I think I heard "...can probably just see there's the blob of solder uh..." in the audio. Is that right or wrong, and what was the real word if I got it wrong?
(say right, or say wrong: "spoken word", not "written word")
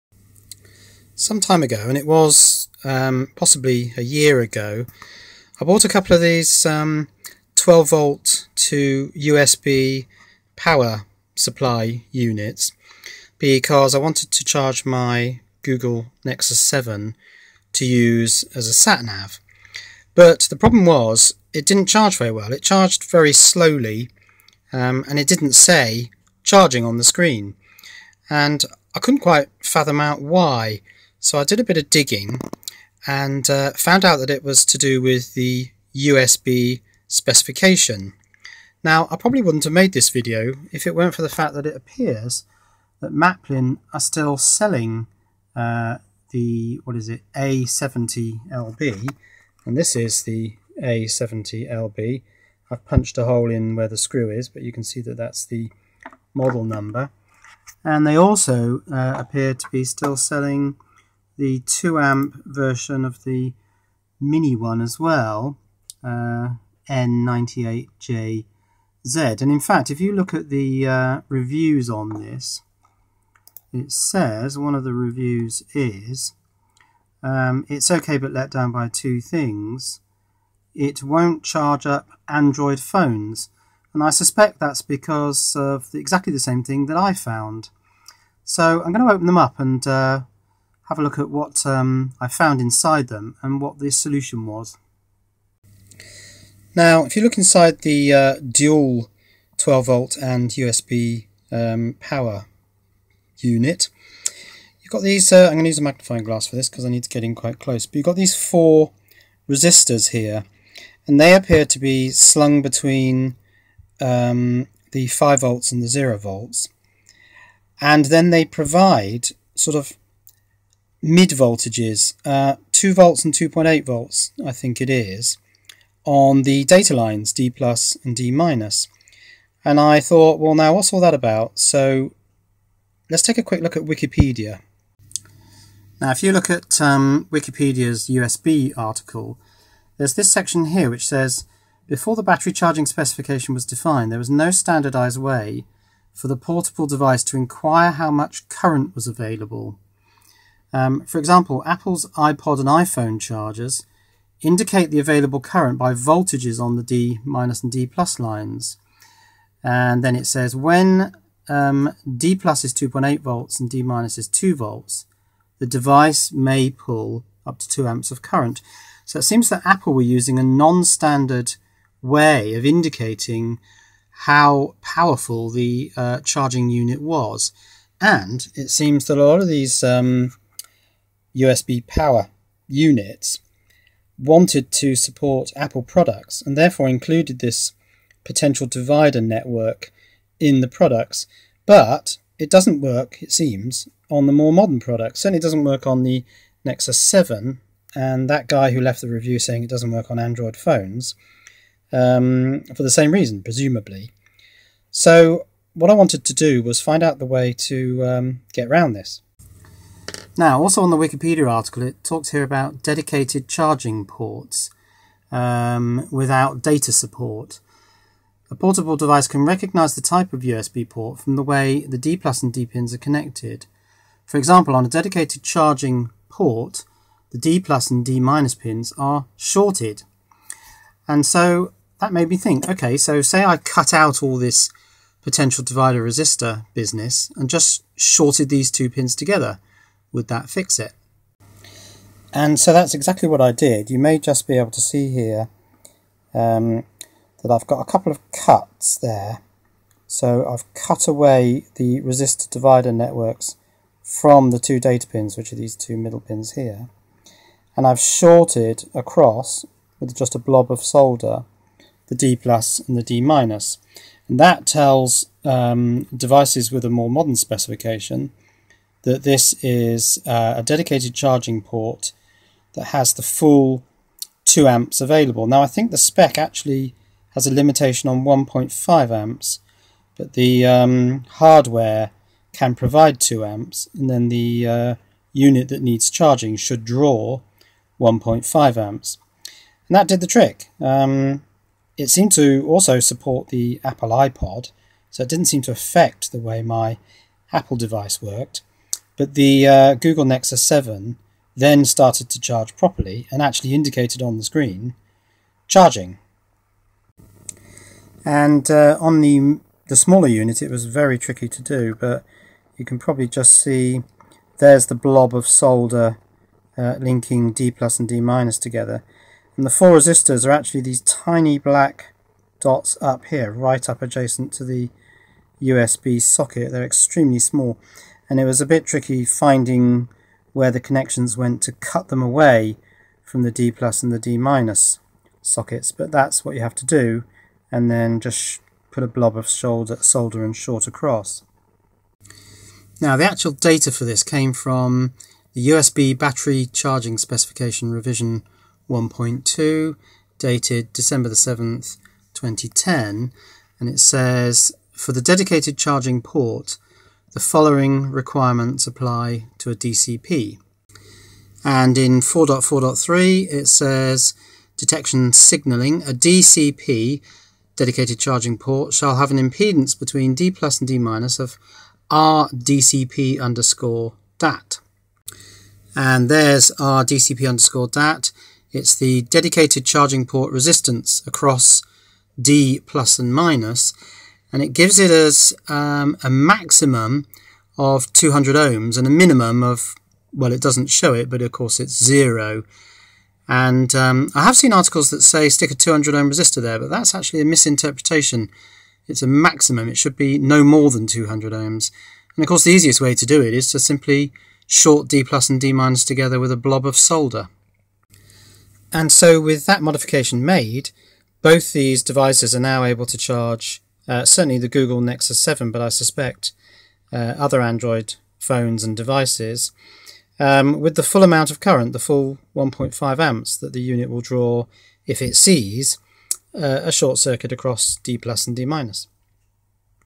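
right.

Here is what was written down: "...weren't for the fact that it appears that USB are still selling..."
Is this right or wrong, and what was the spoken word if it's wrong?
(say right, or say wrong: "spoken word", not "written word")
wrong: "Maplin", not "USB".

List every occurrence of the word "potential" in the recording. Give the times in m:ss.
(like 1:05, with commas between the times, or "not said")
3:08, 3:55.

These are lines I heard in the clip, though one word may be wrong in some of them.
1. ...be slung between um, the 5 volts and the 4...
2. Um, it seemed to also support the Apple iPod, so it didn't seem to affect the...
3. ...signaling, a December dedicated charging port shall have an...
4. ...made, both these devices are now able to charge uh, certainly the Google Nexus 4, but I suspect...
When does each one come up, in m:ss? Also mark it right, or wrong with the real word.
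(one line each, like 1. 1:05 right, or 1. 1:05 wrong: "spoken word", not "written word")
1. 1:51 wrong: "0", not "4"
2. 4:50 right
3. 6:05 wrong: "DCP", not "December"
4. 6:50 wrong: "7", not "4".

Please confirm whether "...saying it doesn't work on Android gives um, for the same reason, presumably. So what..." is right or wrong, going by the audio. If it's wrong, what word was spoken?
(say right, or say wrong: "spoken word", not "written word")
wrong: "phones", not "gives".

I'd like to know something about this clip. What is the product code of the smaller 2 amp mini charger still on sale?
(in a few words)
N98JZ.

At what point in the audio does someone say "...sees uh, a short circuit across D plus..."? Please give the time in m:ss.
7:05.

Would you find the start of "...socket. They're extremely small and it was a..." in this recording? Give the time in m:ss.
5:26.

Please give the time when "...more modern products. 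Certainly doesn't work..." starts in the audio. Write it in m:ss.
3:14.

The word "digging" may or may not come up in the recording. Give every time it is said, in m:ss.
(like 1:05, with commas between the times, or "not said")
0:31.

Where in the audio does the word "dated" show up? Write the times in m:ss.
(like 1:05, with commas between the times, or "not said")
5:50.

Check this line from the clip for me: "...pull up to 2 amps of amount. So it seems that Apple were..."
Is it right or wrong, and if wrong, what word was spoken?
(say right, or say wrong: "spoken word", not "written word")
wrong: "current", not "amount".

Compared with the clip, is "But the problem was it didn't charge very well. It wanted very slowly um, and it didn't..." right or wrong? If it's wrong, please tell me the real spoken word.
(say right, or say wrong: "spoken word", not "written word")
wrong: "charged", not "wanted".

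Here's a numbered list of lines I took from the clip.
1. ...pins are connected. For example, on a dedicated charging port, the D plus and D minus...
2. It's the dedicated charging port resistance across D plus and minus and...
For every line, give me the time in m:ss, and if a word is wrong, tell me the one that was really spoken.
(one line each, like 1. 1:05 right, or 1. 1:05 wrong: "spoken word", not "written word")
1. 3:42 right
2. 6:18 right.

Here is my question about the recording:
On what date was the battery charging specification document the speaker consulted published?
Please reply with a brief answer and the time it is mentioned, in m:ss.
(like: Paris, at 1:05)
7 December 2010, at 5:50.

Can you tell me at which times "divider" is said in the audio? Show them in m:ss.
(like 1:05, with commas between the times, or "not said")
3:08, 3:55, 4:12.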